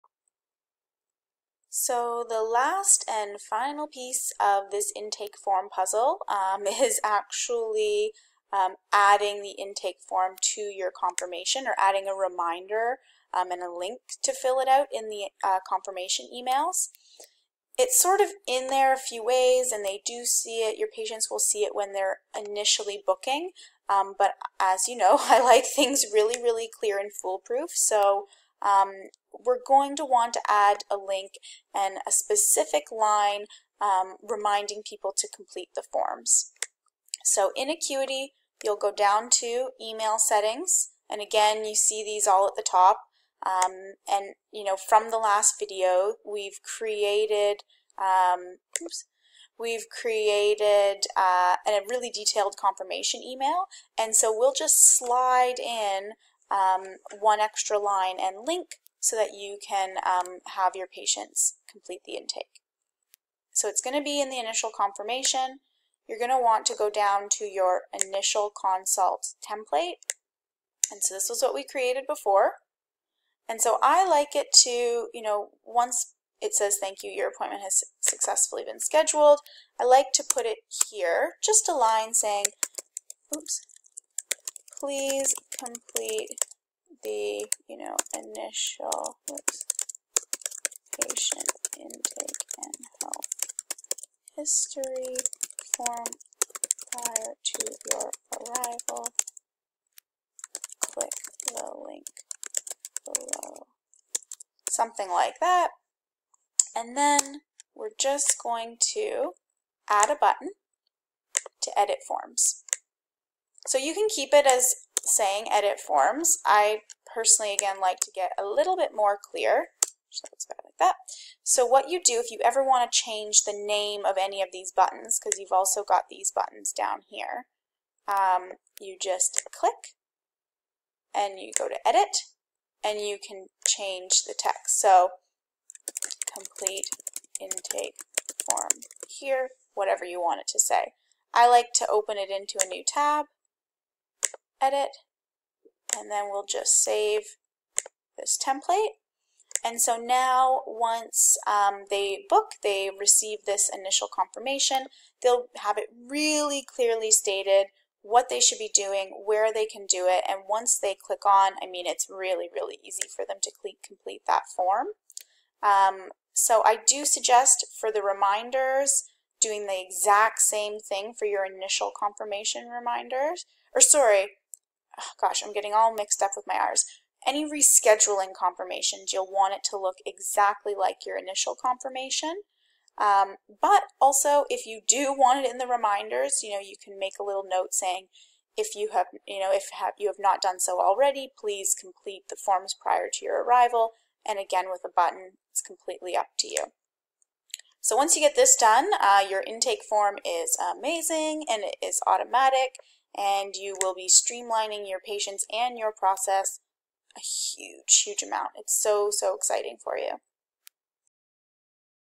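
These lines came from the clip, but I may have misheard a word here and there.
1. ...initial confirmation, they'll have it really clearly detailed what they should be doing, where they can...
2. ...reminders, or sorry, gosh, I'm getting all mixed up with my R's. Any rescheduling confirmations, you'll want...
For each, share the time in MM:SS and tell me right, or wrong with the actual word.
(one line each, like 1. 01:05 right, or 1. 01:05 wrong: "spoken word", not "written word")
1. 02:33 wrong: "stated", not "detailed"
2. 02:52 right.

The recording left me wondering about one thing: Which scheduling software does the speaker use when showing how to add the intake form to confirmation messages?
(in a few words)
Acuity.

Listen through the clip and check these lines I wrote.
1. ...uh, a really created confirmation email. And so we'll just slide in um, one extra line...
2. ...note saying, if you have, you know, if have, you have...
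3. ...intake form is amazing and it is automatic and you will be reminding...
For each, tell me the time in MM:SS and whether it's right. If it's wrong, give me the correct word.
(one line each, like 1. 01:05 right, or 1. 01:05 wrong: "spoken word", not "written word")
1. 00:51 wrong: "detailed", not "created"
2. 03:07 right
3. 03:19 wrong: "streamlining", not "reminding".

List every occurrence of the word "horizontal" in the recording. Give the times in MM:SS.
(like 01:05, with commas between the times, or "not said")
not said.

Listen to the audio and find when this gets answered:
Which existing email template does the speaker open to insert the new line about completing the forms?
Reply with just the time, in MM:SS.
01:07.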